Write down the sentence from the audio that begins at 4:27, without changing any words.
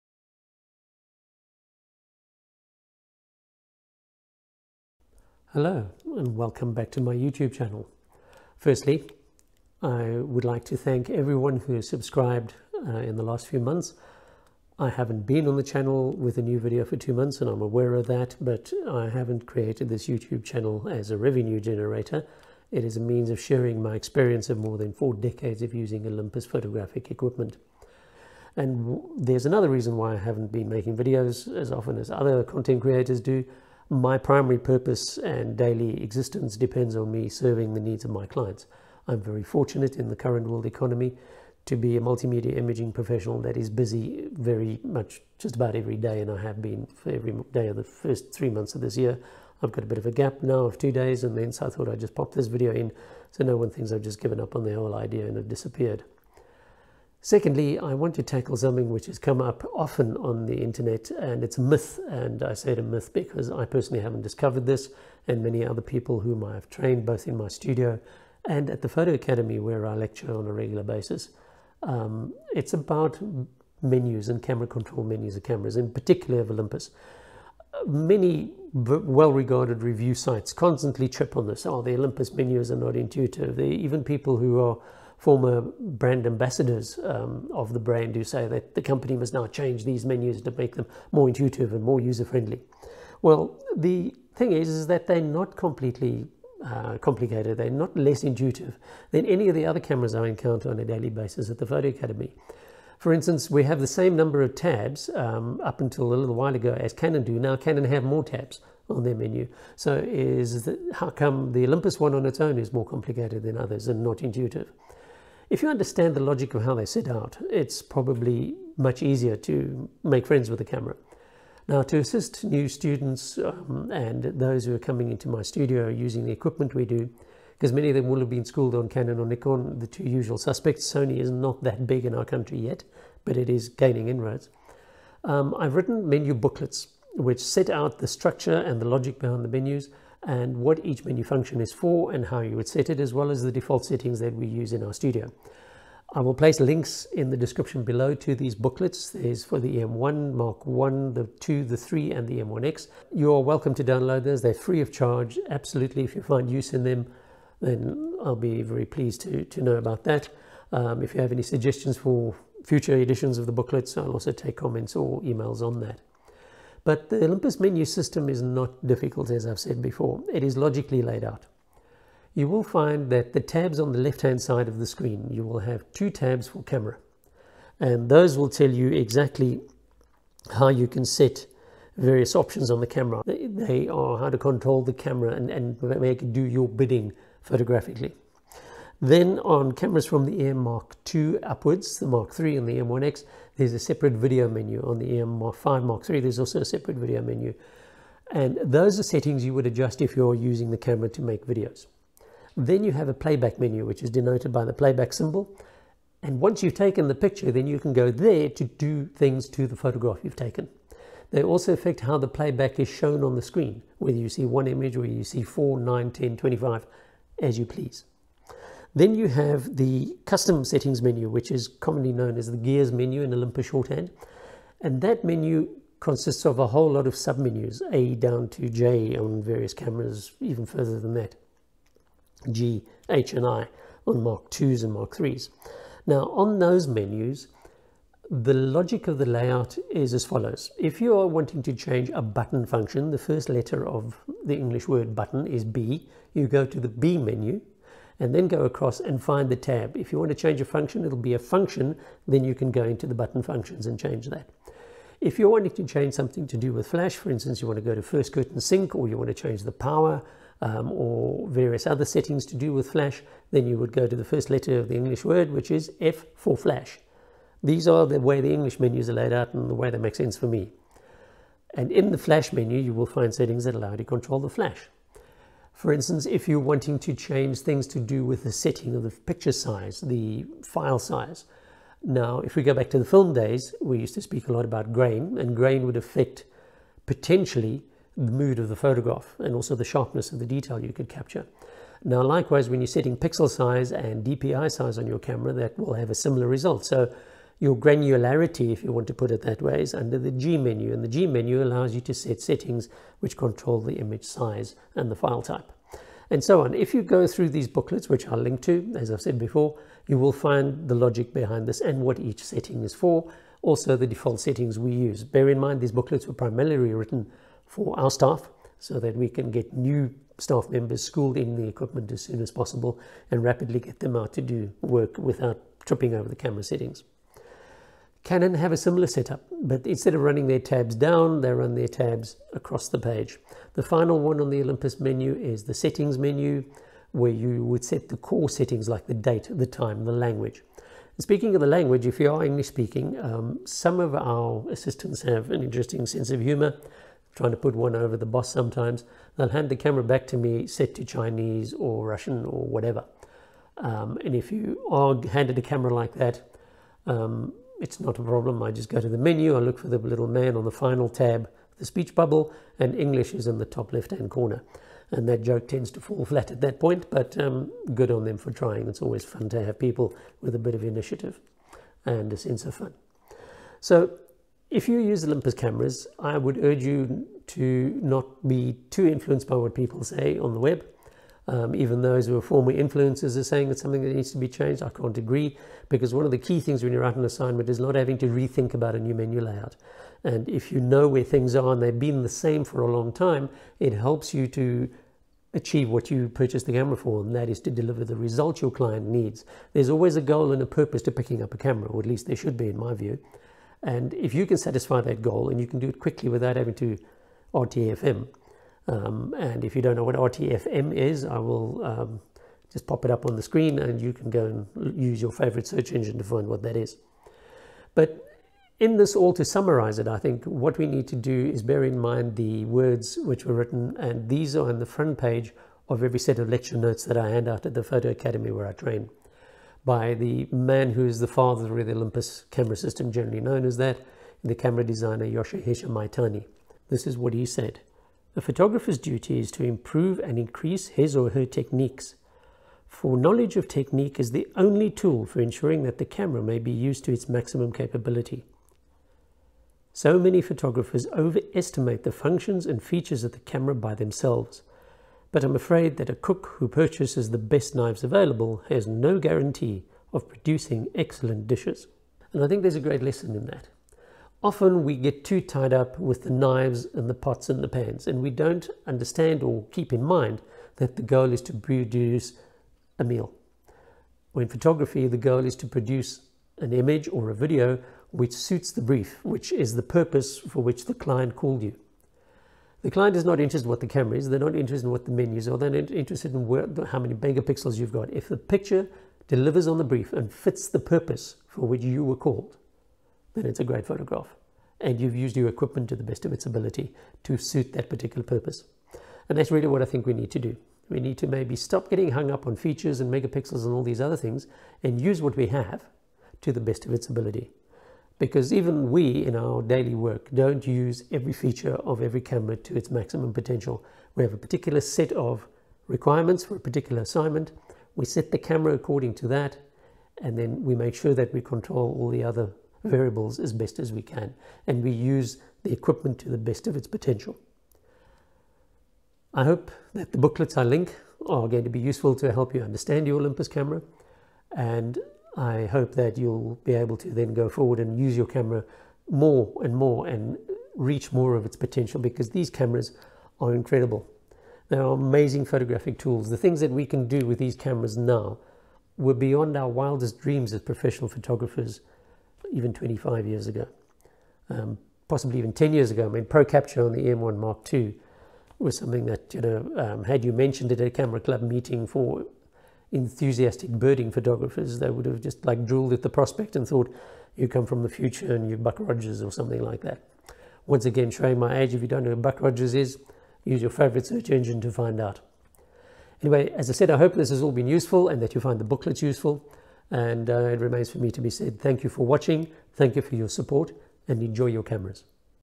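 These are the way the English menus are laid out and the way they make sense for me.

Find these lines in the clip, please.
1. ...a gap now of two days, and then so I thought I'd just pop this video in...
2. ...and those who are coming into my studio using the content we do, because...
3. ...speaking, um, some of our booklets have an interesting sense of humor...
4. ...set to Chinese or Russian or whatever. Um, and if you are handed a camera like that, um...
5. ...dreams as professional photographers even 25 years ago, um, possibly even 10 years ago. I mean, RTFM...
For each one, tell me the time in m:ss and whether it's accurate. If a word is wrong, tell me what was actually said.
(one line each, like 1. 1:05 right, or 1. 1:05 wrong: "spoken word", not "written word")
1. 0:50 right
2. 2:03 wrong: "equipment", not "content"
3. 5:42 wrong: "assistants", not "booklets"
4. 5:50 right
5. 9:10 wrong: "Pro", not "RTFM".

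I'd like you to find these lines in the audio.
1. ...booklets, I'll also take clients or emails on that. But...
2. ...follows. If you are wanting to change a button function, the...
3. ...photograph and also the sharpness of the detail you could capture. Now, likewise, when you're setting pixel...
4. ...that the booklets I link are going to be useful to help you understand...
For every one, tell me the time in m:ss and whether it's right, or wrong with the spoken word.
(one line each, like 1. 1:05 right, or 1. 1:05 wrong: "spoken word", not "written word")
1. 2:43 wrong: "comments", not "clients"
2. 4:00 right
3. 4:48 right
4. 8:49 right.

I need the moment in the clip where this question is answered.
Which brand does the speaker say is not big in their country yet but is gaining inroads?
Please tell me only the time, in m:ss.
2:10.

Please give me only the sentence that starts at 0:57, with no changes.
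Secondly, I want to tackle something which has come up often on the internet, and it's a myth.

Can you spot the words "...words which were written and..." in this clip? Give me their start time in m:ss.
7:02.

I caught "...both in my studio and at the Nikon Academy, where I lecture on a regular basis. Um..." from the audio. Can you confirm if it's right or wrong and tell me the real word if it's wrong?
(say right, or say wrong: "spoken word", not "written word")
wrong: "Photo", not "Nikon".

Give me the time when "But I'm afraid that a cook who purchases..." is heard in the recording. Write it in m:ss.
7:35.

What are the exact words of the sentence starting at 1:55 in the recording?
If you understand the logic of how they set out, it's probably much easier to make friends with the camera.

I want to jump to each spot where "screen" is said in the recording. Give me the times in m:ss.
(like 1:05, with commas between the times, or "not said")
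2:54, 3:33, 6:53.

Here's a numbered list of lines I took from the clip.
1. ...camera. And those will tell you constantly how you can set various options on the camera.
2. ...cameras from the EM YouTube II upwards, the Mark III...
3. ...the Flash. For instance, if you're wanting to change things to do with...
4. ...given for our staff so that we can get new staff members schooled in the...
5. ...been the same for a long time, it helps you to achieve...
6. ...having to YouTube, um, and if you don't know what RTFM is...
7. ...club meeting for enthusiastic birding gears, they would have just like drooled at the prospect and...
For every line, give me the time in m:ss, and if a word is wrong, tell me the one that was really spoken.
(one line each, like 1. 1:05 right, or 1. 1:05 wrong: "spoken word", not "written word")
1. 2:56 wrong: "exactly", not "constantly"
2. 3:09 wrong: "Mark", not "YouTube"
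3. 4:34 right
4. 5:17 wrong: "written", not "given"
5. 6:31 right
6. 6:46 wrong: "RTFM", not "YouTube"
7. 9:21 wrong: "photographers", not "gears".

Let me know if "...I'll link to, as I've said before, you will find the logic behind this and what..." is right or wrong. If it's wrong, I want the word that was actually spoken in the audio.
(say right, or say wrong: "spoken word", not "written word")
right.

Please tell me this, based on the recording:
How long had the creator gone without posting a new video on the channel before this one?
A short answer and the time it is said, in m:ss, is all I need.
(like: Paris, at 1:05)
two months, at 0:16.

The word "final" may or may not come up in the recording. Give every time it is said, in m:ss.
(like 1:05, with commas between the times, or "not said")
5:33, 6:00.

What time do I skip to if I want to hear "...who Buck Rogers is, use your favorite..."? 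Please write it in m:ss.
9:32.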